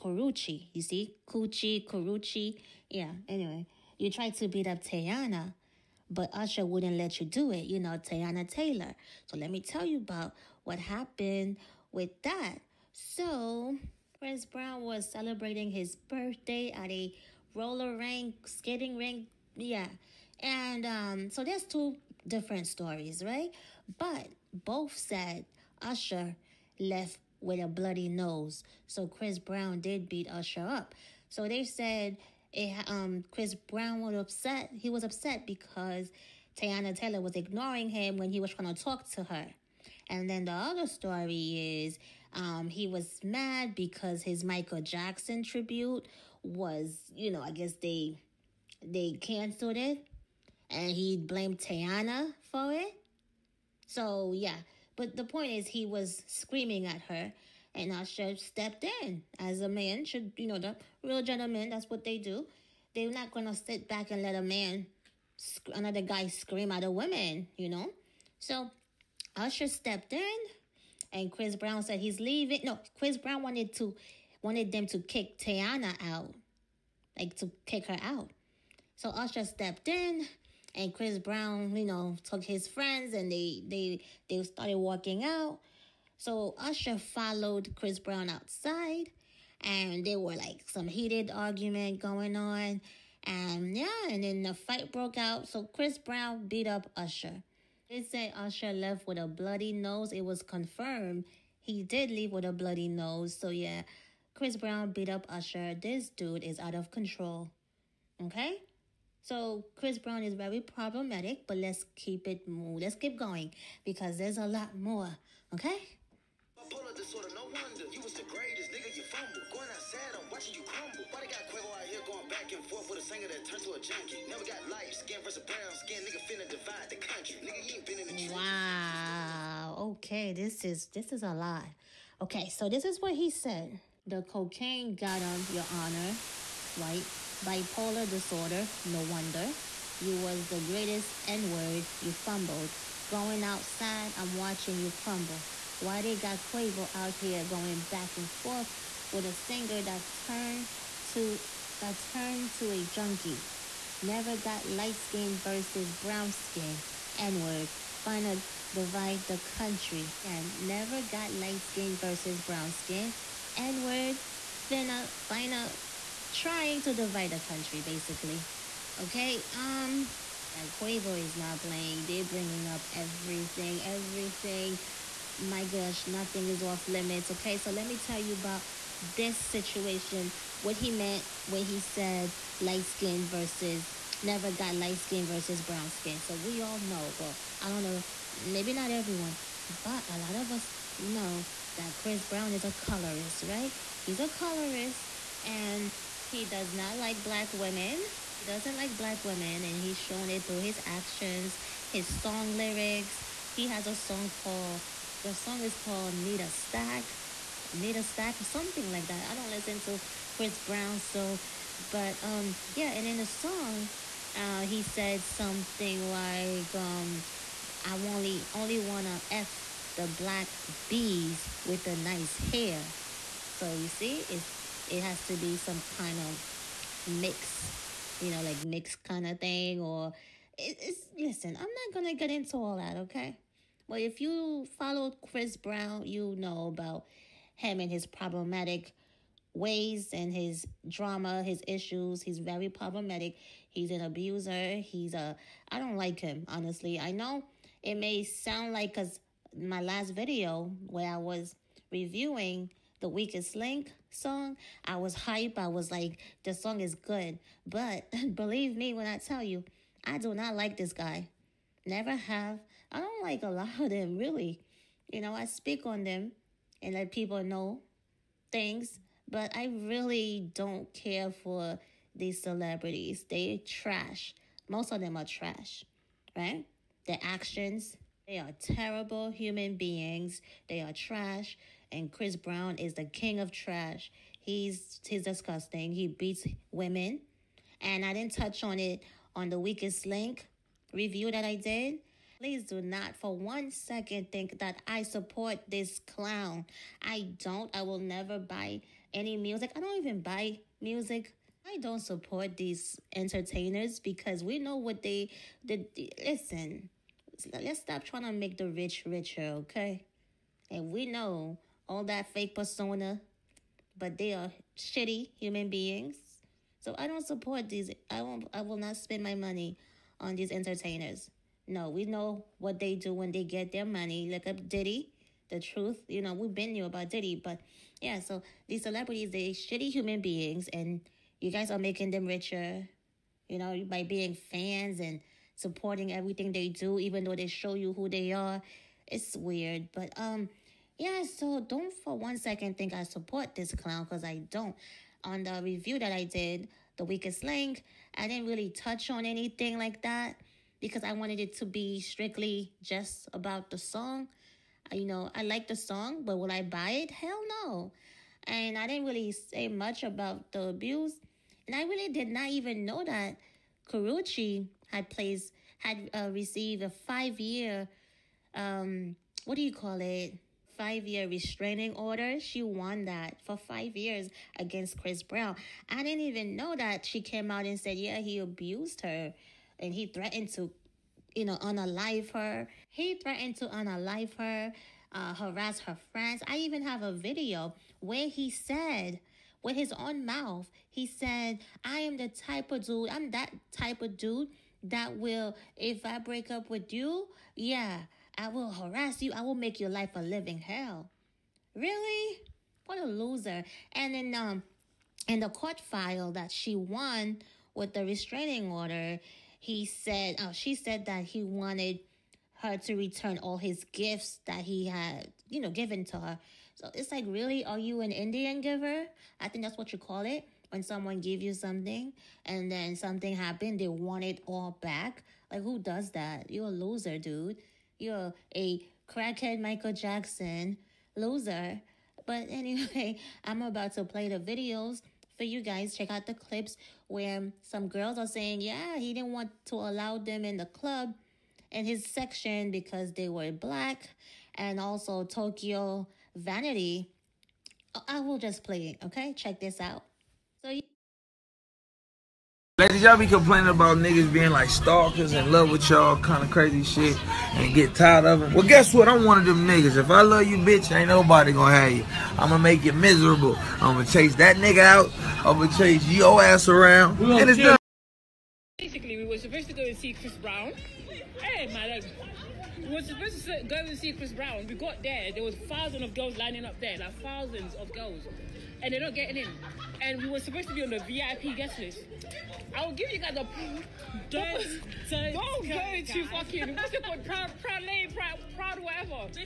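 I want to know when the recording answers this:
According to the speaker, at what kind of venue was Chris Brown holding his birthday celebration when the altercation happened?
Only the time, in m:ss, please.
0:17.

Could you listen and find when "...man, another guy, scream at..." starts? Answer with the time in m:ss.
1:04.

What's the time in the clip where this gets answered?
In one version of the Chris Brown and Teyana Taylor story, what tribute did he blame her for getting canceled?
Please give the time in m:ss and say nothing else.
0:44.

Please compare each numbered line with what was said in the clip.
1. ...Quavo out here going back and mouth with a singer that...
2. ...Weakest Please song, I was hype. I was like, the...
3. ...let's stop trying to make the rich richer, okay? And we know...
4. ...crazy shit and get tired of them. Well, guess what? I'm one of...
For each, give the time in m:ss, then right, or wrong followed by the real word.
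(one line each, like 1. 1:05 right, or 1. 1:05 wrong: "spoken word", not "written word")
1. 2:26 wrong: "forth", not "mouth"
2. 4:13 wrong: "Link", not "Please"
3. 5:07 right
4. 7:36 right.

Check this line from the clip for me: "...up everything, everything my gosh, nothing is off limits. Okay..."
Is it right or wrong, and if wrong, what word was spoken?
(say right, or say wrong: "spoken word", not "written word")
right.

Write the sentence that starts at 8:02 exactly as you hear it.
I'll give you guys a don't don't, don't go too to fucking what's it called proud proud proud proud whatever.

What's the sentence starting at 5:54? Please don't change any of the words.
Uh, you know, I like the song, but will I buy it?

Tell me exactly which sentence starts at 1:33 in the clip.
And yeah, and then the fight broke out.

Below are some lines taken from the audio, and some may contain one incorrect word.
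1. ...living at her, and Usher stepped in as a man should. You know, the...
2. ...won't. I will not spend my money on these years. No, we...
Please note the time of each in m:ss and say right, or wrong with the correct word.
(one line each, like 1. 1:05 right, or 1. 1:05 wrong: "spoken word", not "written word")
1. 0:56 wrong: "screaming", not "living"
2. 5:18 wrong: "entertainers", not "years".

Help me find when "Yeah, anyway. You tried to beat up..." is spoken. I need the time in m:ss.
0:02.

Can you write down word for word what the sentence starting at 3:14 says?
He's a colorist and he does not like black women.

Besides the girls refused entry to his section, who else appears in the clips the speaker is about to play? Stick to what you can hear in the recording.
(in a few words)
Tokyo Vanity.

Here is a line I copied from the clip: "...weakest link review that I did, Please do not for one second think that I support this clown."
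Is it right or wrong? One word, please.
right.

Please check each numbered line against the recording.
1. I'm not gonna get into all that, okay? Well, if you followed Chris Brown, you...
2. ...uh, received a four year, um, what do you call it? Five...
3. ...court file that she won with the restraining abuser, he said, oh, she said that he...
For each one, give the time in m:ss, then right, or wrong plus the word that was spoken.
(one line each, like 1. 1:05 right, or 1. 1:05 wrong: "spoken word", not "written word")
1. 3:51 right
2. 6:06 wrong: "five", not "four"
3. 6:45 wrong: "order", not "abuser".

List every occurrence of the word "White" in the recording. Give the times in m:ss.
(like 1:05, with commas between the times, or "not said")
2:16.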